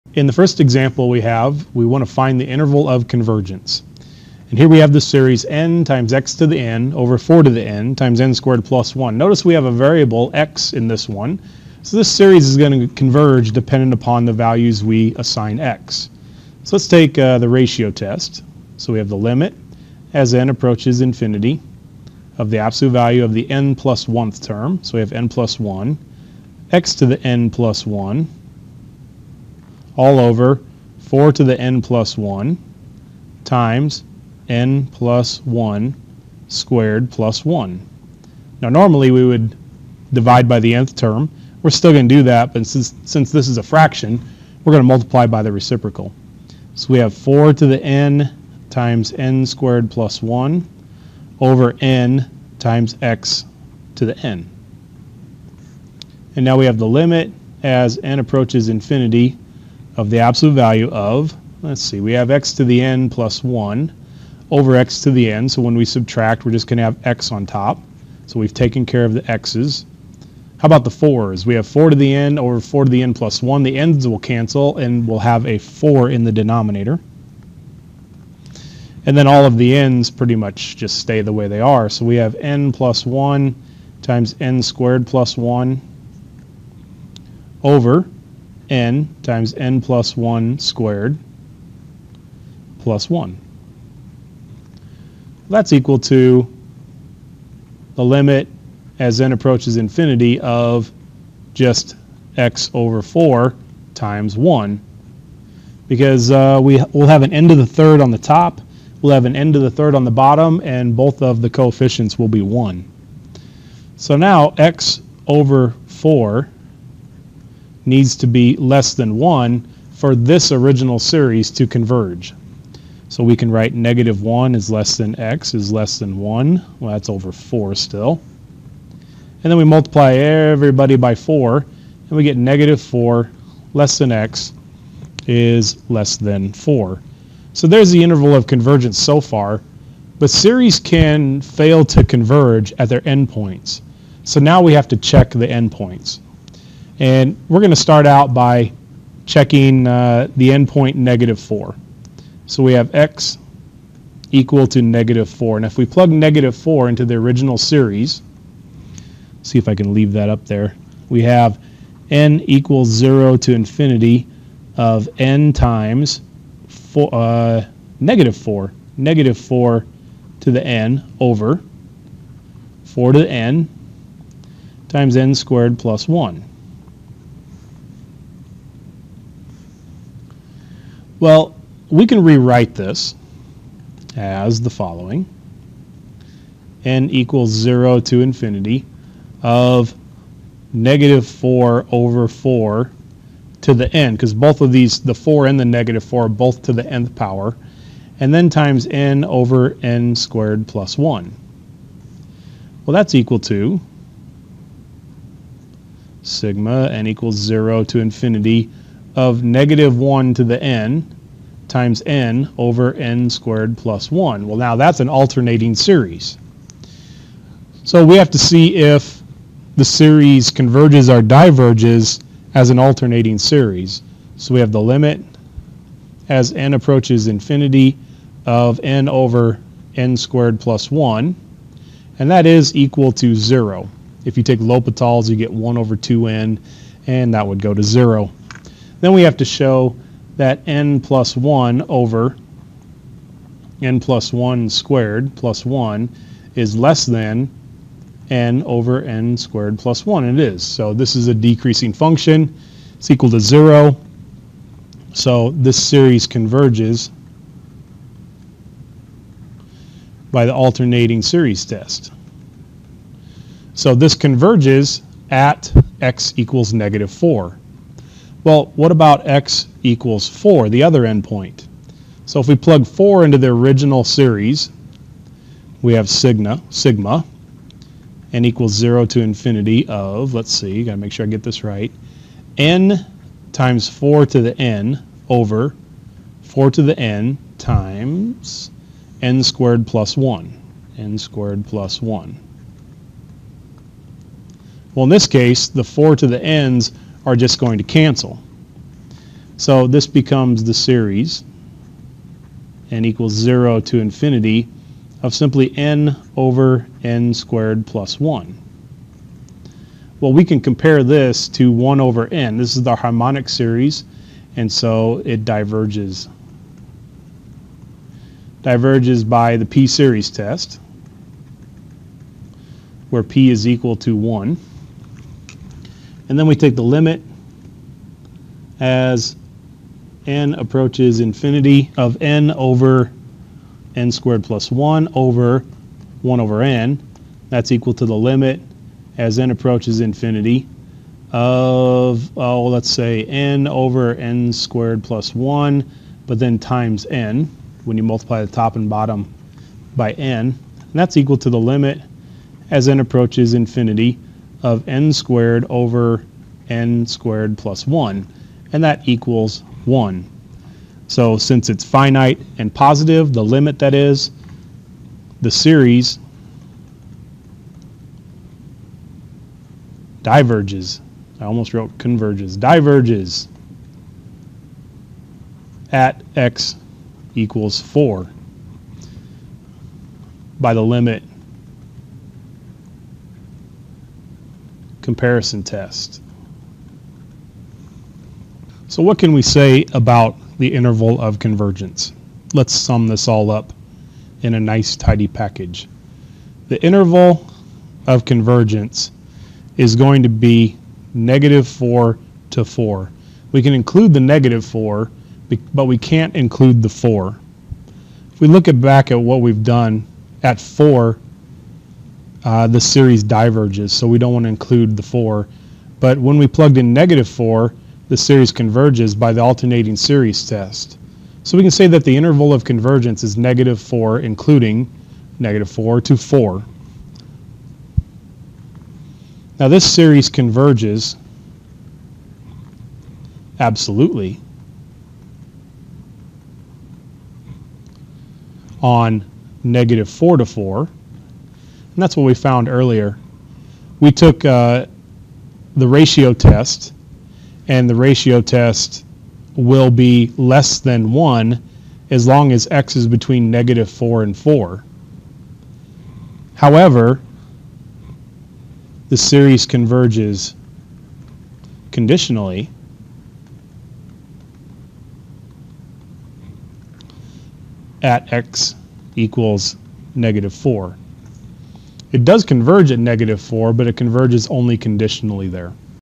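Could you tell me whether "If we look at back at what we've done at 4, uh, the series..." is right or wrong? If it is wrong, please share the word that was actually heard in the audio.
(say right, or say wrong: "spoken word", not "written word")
right.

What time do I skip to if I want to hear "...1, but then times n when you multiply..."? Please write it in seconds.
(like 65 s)
345 s.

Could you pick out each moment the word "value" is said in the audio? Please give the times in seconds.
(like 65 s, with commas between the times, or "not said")
14 s, 22 s, 60 s.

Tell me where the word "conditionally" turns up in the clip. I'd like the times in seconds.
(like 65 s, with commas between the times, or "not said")
461 s, 474 s.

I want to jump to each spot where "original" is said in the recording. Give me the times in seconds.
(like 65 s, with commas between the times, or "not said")
120 s, 157 s, 273 s.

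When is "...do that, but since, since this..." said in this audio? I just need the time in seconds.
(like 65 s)
42 s.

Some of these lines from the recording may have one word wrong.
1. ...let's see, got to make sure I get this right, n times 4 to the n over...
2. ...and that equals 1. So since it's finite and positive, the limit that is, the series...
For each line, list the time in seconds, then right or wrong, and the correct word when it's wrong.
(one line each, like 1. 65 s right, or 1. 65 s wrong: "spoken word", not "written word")
1. 280 s right
2. 358 s right.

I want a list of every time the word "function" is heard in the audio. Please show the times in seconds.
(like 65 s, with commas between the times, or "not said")
251 s.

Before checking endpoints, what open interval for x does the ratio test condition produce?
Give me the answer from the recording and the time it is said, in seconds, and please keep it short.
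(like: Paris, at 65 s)
-4 < x < 4, at 132 s.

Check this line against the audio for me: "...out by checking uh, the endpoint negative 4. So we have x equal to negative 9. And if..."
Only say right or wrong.
wrong.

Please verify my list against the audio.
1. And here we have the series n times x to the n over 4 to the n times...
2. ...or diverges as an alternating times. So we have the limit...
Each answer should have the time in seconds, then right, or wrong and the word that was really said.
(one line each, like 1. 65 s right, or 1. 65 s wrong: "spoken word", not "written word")
1. 4 s right
2. 221 s wrong: "series", not "times".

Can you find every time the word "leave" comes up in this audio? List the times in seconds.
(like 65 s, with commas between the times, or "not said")
159 s.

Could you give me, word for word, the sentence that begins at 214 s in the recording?
Well, now that's an alternating series.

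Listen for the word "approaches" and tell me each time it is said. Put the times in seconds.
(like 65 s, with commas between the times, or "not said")
20 s, 58 s, 99 s, 226 s, 330 s, 339 s, 353 s.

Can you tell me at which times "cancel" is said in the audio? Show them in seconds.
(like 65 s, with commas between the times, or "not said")
74 s, 297 s.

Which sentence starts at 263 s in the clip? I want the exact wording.
So this converges at x equals negative 4.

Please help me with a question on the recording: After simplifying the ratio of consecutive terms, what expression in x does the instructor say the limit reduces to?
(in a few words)
x/4.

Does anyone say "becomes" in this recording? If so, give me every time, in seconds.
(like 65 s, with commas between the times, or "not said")
300 s.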